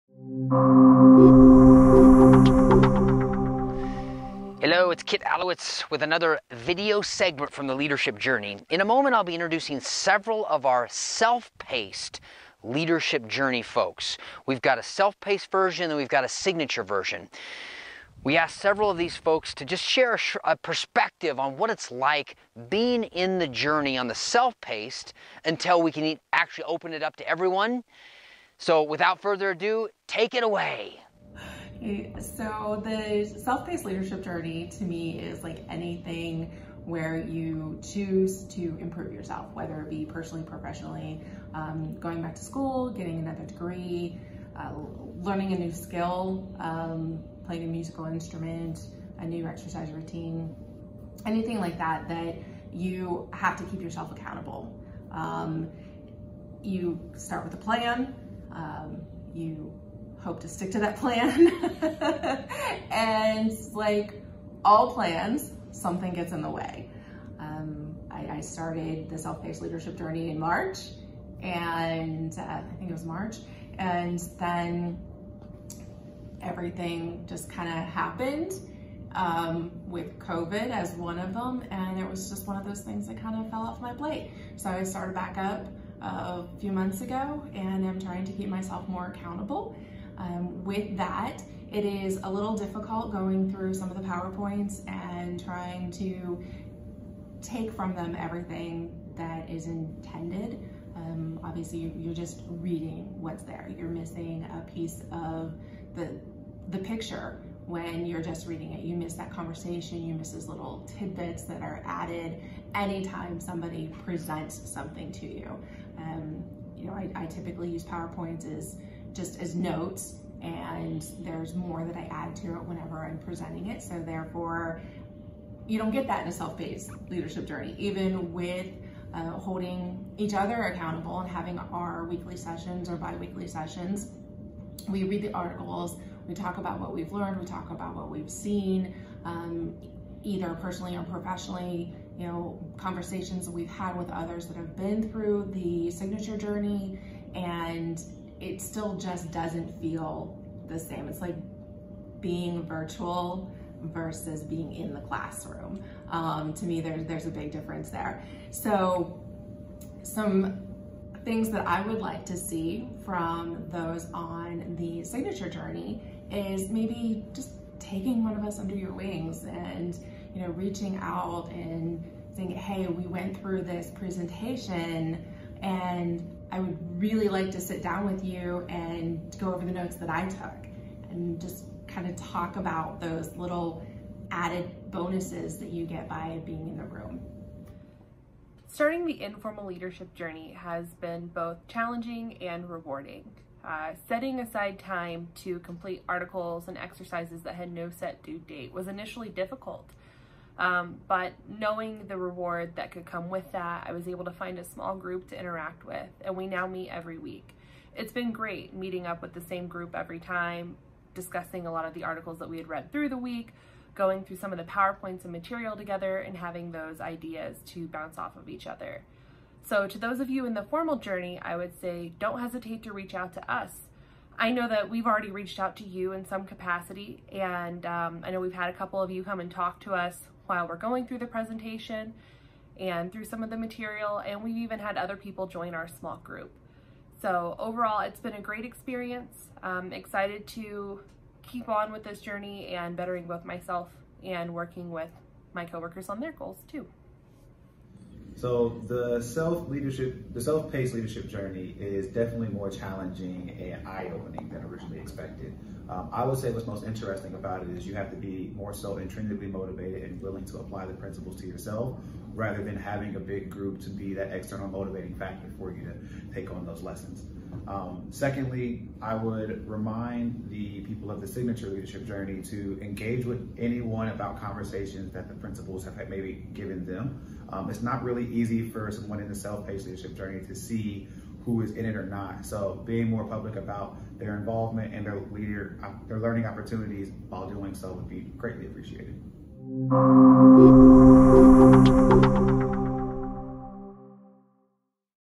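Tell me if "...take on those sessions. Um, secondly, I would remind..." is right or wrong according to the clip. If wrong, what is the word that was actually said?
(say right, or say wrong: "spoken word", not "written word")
wrong: "lessons", not "sessions".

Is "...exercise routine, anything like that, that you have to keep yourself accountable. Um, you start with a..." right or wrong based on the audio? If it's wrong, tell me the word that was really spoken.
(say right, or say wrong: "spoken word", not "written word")
right.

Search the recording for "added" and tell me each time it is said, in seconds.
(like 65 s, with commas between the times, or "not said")
111 s, 184 s.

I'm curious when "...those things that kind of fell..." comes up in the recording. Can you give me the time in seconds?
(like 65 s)
82 s.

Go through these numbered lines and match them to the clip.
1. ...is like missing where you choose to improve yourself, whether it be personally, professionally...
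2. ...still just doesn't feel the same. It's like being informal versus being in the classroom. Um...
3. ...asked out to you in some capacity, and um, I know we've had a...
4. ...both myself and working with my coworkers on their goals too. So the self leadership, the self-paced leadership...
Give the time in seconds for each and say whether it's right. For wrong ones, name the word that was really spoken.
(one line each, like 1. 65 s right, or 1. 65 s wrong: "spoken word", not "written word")
1. 35 s wrong: "anything", not "missing"
2. 148 s wrong: "virtual", not "informal"
3. 225 s wrong: "reached", not "asked"
4. 243 s right.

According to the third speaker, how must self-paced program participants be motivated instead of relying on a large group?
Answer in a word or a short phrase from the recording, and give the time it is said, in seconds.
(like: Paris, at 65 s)
intrinsically, at 258 s.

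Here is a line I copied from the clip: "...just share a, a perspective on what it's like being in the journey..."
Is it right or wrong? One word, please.
right.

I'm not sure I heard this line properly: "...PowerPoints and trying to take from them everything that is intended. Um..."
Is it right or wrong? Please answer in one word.
right.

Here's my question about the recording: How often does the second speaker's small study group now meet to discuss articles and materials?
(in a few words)
every week.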